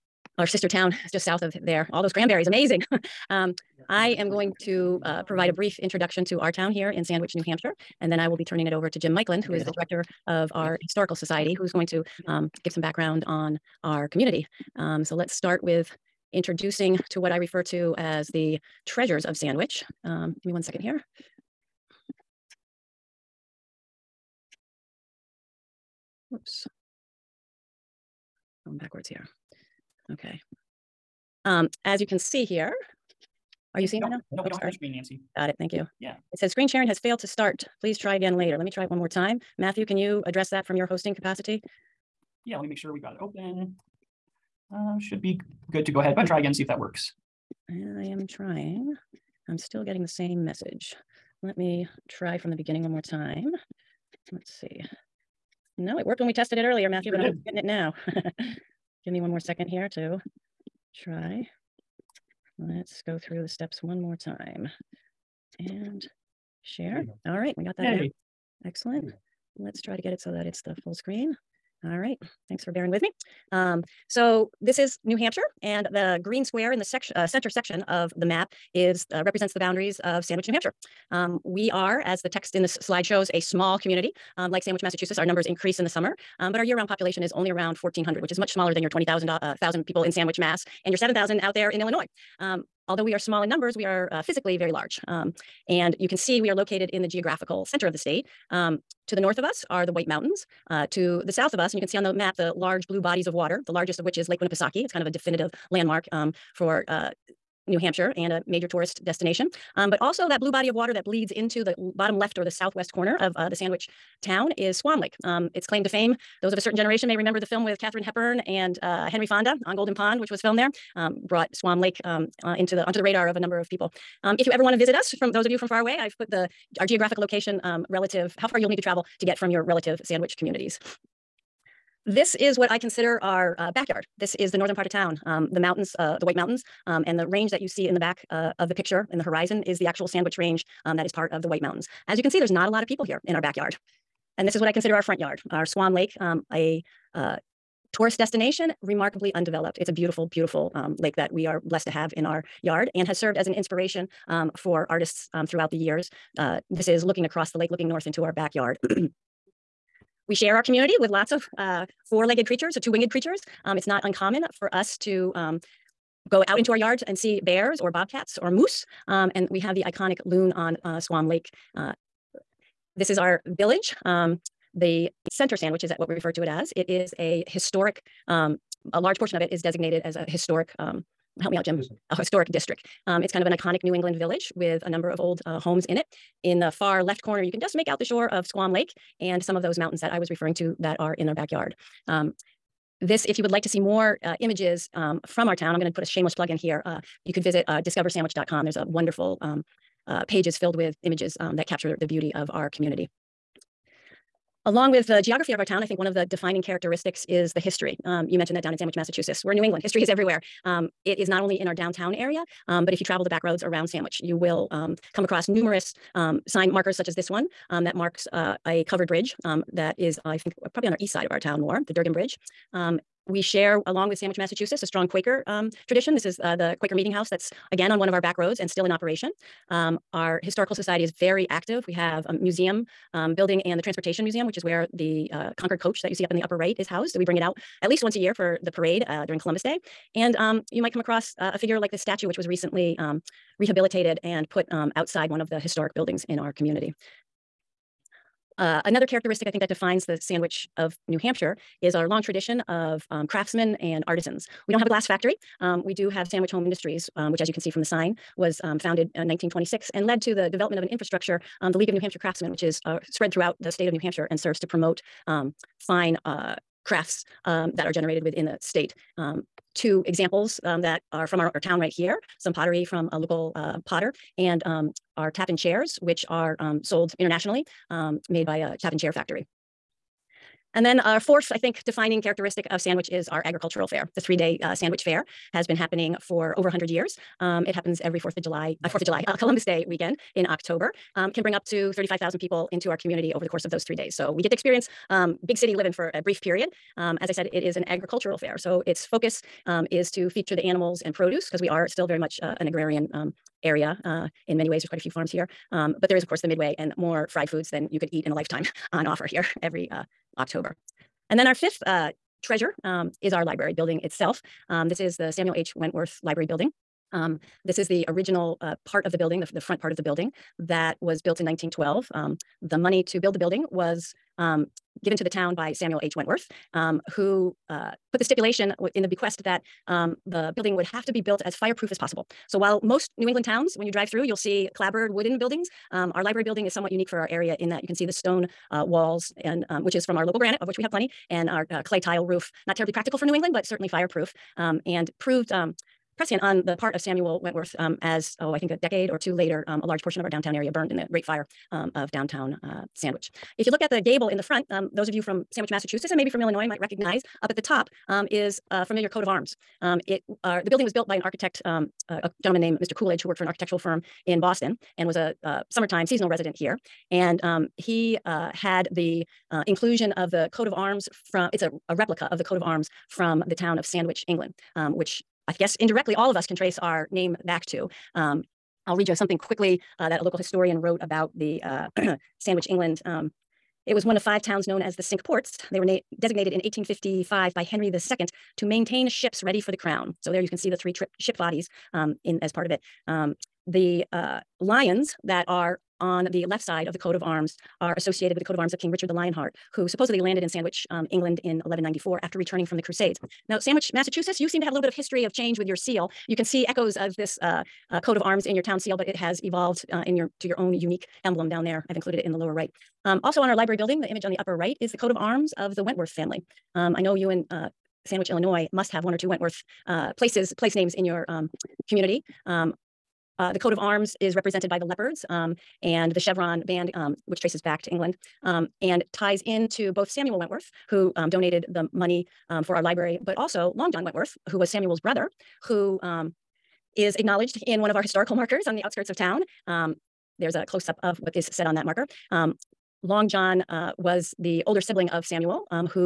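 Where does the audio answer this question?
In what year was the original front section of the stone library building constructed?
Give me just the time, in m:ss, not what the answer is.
5:21.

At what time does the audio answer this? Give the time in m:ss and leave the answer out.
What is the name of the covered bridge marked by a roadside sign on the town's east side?
3:41.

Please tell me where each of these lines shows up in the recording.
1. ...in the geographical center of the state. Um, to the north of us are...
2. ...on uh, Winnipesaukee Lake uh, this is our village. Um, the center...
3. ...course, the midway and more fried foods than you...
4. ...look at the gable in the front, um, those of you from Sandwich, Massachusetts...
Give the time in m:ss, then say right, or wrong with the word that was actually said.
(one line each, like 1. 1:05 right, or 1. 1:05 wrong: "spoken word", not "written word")
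1. 1:36 right
2. 2:50 wrong: "Squam", not "Winnipesaukee"
3. 5:06 right
4. 5:53 right.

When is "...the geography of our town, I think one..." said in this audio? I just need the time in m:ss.
3:25.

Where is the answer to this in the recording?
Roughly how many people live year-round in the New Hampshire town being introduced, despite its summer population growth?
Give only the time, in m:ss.
1:27.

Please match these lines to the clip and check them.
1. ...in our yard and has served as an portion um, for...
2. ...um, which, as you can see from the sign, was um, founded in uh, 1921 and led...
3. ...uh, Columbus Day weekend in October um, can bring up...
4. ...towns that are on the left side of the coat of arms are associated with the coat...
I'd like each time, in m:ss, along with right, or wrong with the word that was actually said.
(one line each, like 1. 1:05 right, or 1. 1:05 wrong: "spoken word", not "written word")
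1. 2:32 wrong: "inspiration", not "portion"
2. 4:17 wrong: "1926", not "1921"
3. 4:49 right
4. 6:34 wrong: "lions", not "towns".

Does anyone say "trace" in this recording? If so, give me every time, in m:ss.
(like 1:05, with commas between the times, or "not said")
6:16, 7:07.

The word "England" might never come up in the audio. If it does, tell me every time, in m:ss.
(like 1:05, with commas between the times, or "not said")
3:03, 3:29, 5:33, 5:43, 6:14, 6:22, 6:41, 7:07.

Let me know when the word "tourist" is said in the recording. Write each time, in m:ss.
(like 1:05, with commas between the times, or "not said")
1:48, 2:27.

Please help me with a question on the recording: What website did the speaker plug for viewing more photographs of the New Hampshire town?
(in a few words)
discoversandwich.com.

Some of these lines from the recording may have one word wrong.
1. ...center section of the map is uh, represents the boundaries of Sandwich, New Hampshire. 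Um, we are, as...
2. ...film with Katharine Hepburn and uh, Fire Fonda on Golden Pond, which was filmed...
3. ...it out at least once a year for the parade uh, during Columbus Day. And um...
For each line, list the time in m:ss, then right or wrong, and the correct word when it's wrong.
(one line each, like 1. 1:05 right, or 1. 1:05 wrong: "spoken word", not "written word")
1. 1:17 right
2. 1:57 wrong: "Henry", not "Fire"
3. 3:57 right.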